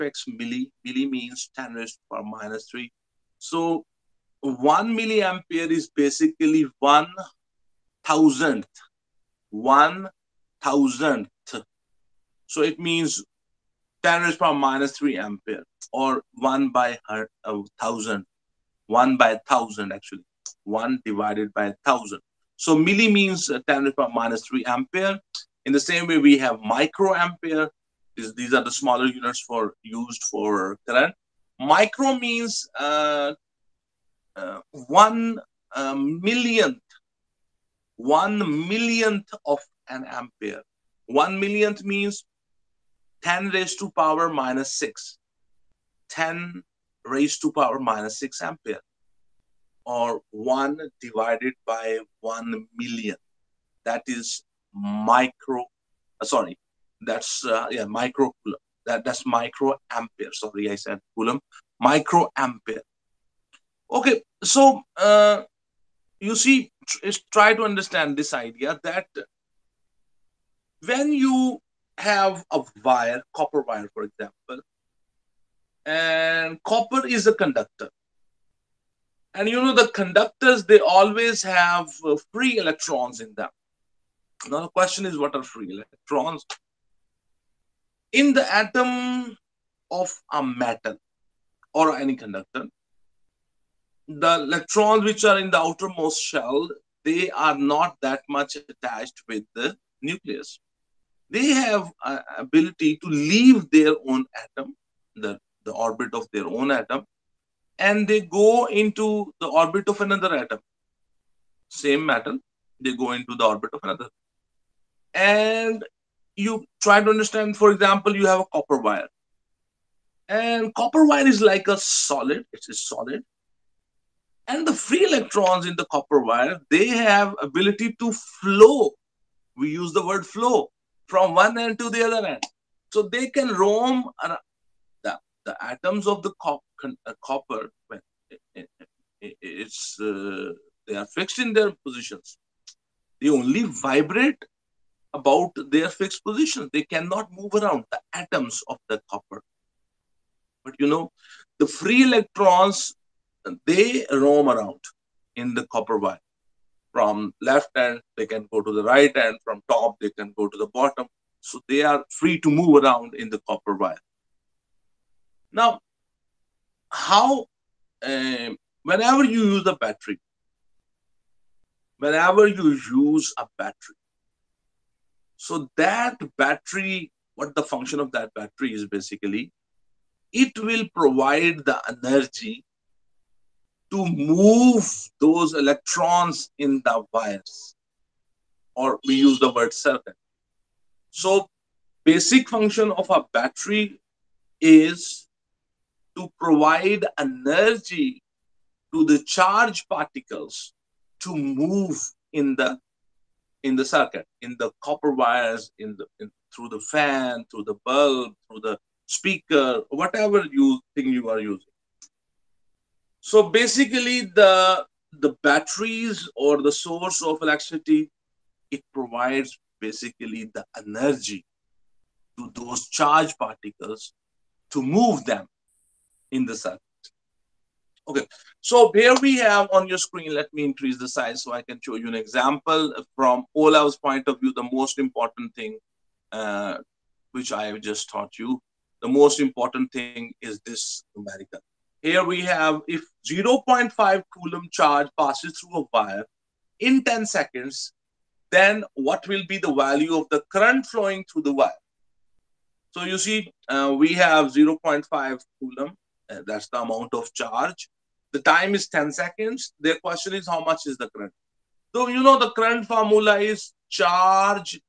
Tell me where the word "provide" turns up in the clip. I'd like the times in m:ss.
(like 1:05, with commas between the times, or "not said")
3:00, 3:16, 3:38.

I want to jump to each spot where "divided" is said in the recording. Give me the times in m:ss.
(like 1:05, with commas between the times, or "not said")
0:21, 0:51.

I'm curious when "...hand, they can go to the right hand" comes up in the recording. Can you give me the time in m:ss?
2:37.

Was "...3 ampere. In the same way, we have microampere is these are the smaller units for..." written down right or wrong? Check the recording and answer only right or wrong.
right.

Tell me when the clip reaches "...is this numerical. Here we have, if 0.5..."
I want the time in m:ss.
4:00.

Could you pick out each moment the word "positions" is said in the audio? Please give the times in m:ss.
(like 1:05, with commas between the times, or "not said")
2:21, 2:26.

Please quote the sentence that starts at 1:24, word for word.
Now, the question is, what are free electrons?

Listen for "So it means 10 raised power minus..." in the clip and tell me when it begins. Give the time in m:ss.
0:12.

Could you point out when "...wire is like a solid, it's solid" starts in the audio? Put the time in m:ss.
2:01.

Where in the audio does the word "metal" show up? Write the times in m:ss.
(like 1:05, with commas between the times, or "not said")
1:30, 1:52.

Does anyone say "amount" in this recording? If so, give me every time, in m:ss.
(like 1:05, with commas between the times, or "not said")
4:16.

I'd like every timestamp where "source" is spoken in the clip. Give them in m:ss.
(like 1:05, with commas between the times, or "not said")
3:36.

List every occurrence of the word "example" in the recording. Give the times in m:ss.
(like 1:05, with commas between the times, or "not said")
1:14, 1:57, 3:52.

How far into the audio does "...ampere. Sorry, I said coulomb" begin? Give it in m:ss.
0:59.